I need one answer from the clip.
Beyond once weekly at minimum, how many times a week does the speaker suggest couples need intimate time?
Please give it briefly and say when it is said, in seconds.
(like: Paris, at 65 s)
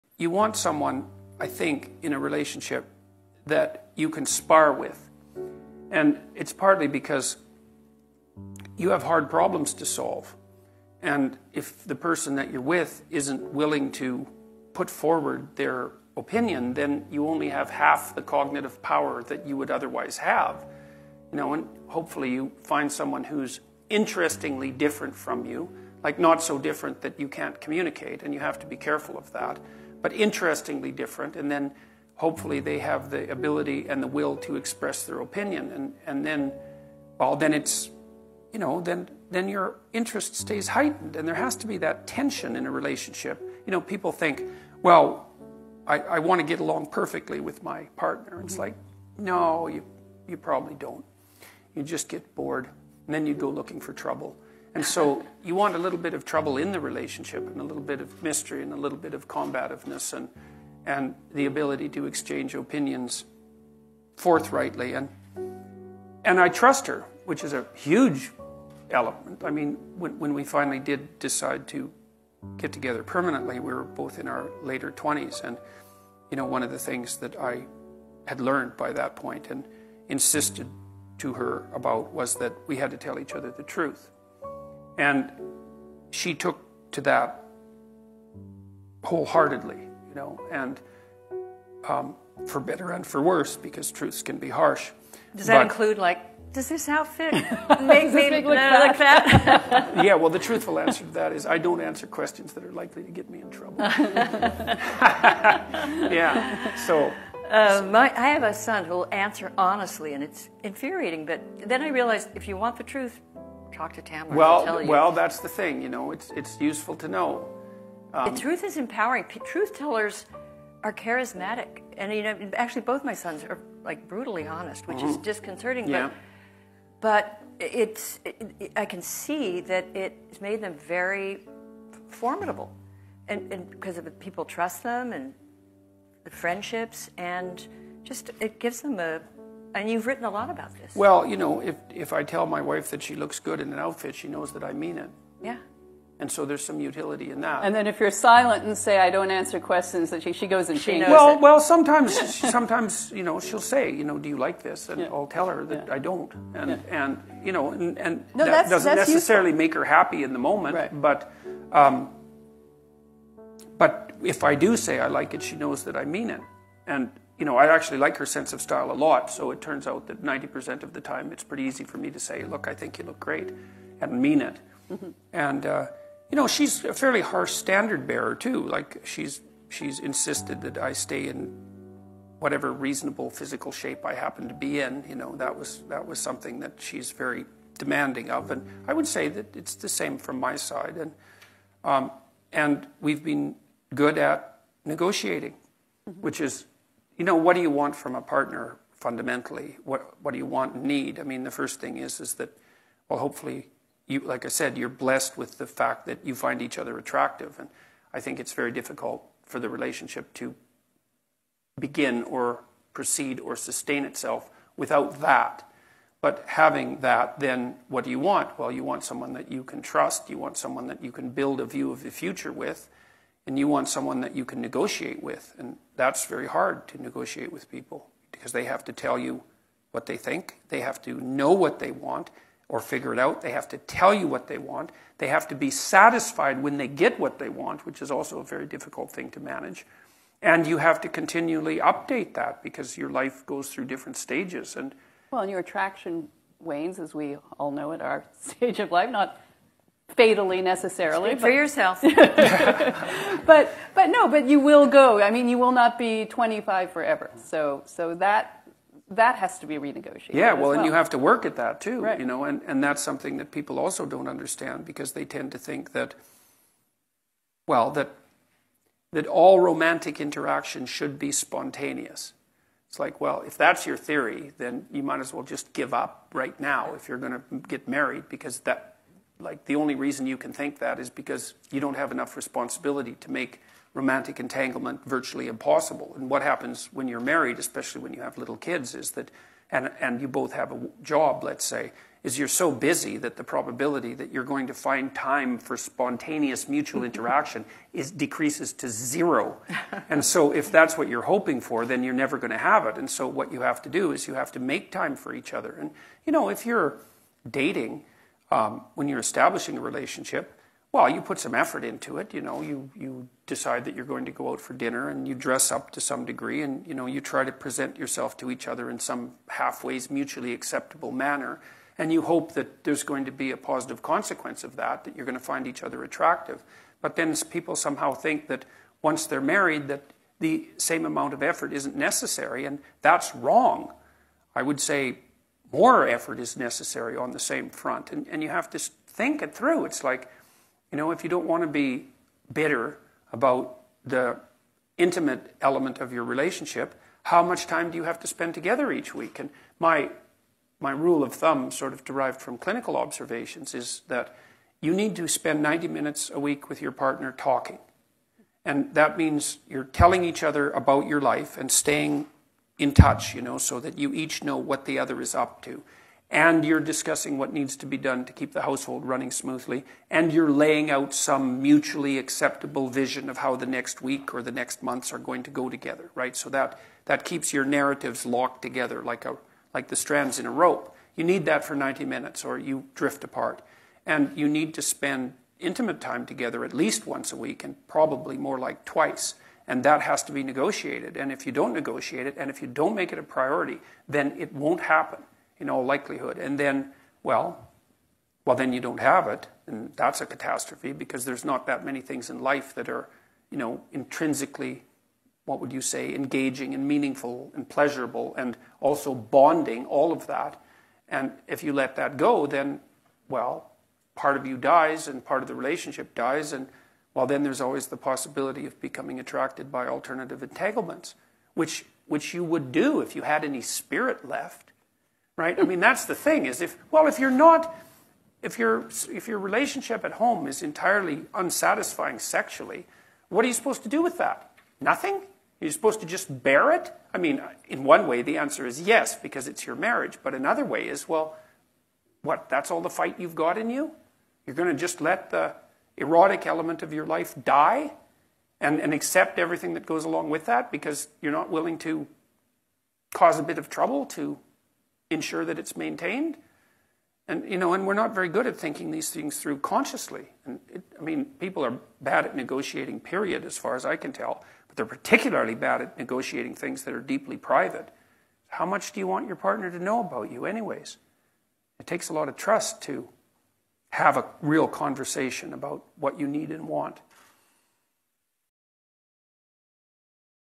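twice, at 388 s.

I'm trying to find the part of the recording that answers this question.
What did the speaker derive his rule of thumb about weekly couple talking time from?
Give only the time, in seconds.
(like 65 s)
352 s.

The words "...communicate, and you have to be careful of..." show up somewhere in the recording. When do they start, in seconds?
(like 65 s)
27 s.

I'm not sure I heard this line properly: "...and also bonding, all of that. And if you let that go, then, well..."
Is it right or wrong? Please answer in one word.
right.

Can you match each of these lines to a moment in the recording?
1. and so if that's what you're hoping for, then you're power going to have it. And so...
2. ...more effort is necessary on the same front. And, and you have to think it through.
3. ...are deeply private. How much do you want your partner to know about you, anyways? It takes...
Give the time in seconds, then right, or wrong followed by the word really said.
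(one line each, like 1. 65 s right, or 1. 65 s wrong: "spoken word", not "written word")
1. 300 s wrong: "never", not "power"
2. 335 s right
3. 466 s right.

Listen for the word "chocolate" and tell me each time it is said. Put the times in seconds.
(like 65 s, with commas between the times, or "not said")
not said.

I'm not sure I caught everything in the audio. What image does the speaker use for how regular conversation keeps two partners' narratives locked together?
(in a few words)
strands in a rope.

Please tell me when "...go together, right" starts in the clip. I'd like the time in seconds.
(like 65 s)
375 s.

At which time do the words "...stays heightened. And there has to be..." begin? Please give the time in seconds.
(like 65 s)
40 s.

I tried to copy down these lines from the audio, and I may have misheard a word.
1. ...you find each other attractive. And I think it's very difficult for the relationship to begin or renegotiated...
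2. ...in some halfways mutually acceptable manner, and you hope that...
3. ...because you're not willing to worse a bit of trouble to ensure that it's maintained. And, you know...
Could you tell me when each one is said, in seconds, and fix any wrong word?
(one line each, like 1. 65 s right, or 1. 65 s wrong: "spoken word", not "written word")
1. 206 s wrong: "proceed", not "renegotiated"
2. 318 s right
3. 450 s wrong: "cause", not "worse".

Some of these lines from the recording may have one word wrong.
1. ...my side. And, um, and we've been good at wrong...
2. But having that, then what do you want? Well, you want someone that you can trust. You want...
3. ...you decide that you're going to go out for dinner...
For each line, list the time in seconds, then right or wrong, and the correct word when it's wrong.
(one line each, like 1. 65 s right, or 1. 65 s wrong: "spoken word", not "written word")
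1. 190 s wrong: "negotiating", not "wrong"
2. 216 s right
3. 312 s right.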